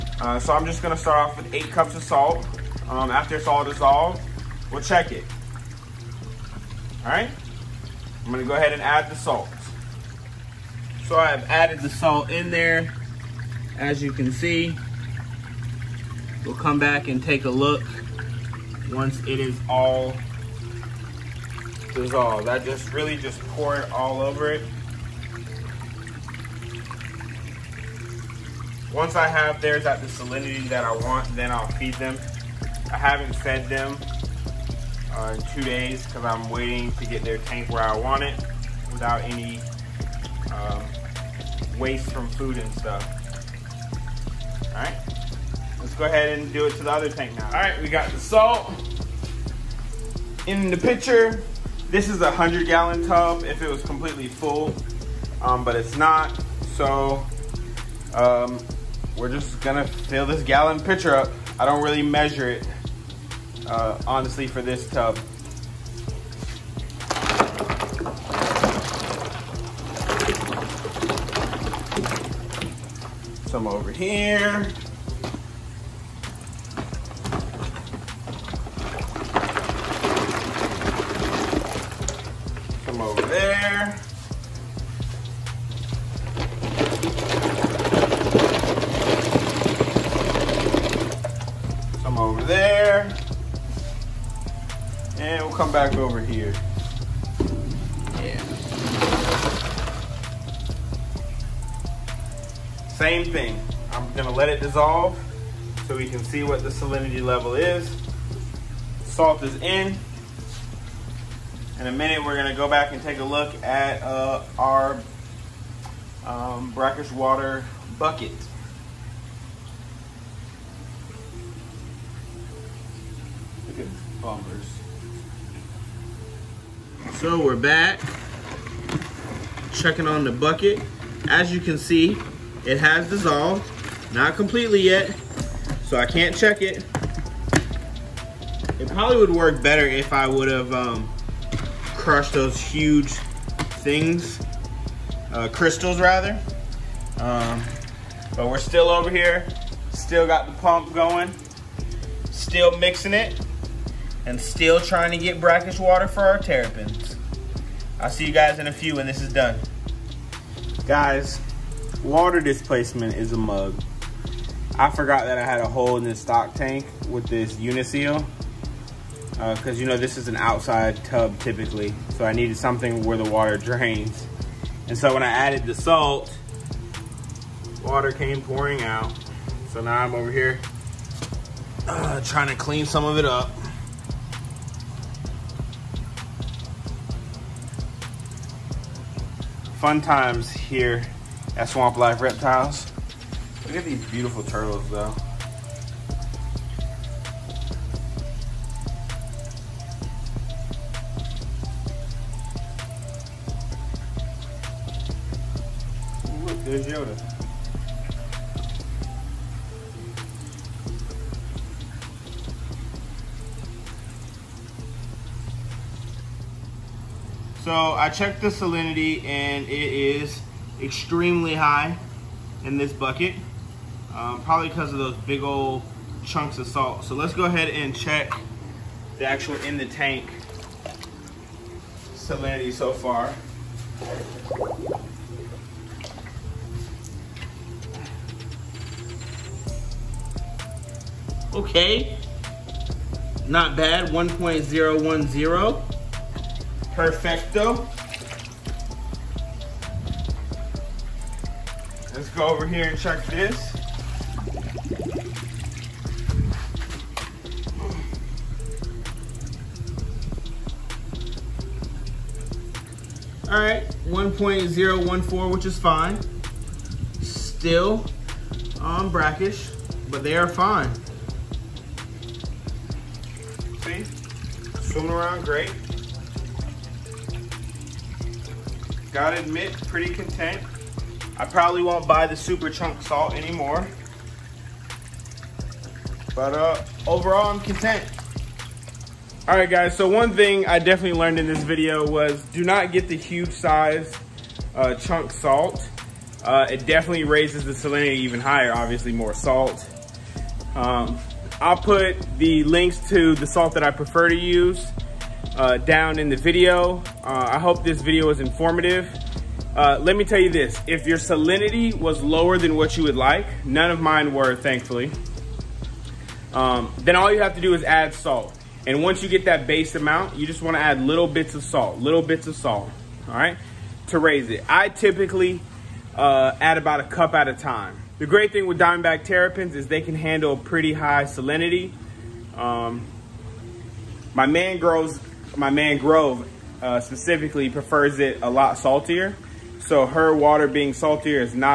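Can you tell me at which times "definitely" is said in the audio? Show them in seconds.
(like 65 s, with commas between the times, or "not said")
290 s, 296 s.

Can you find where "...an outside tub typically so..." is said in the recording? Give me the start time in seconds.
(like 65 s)
170 s.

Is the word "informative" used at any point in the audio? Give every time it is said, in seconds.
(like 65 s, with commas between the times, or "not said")
308 s.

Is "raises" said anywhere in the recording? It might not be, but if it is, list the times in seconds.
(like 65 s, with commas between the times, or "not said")
297 s, 324 s.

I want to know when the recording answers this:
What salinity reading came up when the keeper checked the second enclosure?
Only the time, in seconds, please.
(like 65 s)
264 s.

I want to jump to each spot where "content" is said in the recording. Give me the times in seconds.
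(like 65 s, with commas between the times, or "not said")
280 s, 287 s.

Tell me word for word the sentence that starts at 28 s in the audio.
Once I have theirs at the salinity that I want, then I'll feed them.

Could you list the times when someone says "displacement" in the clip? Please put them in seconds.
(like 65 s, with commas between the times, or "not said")
162 s.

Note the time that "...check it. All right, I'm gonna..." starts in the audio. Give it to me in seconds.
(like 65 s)
4 s.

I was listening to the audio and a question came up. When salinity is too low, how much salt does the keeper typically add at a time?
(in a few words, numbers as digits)
a cup.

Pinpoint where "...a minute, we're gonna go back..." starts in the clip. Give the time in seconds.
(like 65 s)
111 s.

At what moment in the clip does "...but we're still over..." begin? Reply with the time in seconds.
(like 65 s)
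148 s.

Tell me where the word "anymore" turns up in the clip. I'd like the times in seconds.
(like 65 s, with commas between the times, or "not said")
283 s.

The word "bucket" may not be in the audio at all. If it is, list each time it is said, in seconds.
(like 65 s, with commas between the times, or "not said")
117 s, 130 s, 222 s.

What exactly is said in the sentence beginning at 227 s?
So let's go ahead and check the actual in the tank salinity so far.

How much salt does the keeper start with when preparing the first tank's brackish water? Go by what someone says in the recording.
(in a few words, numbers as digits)
8 cups.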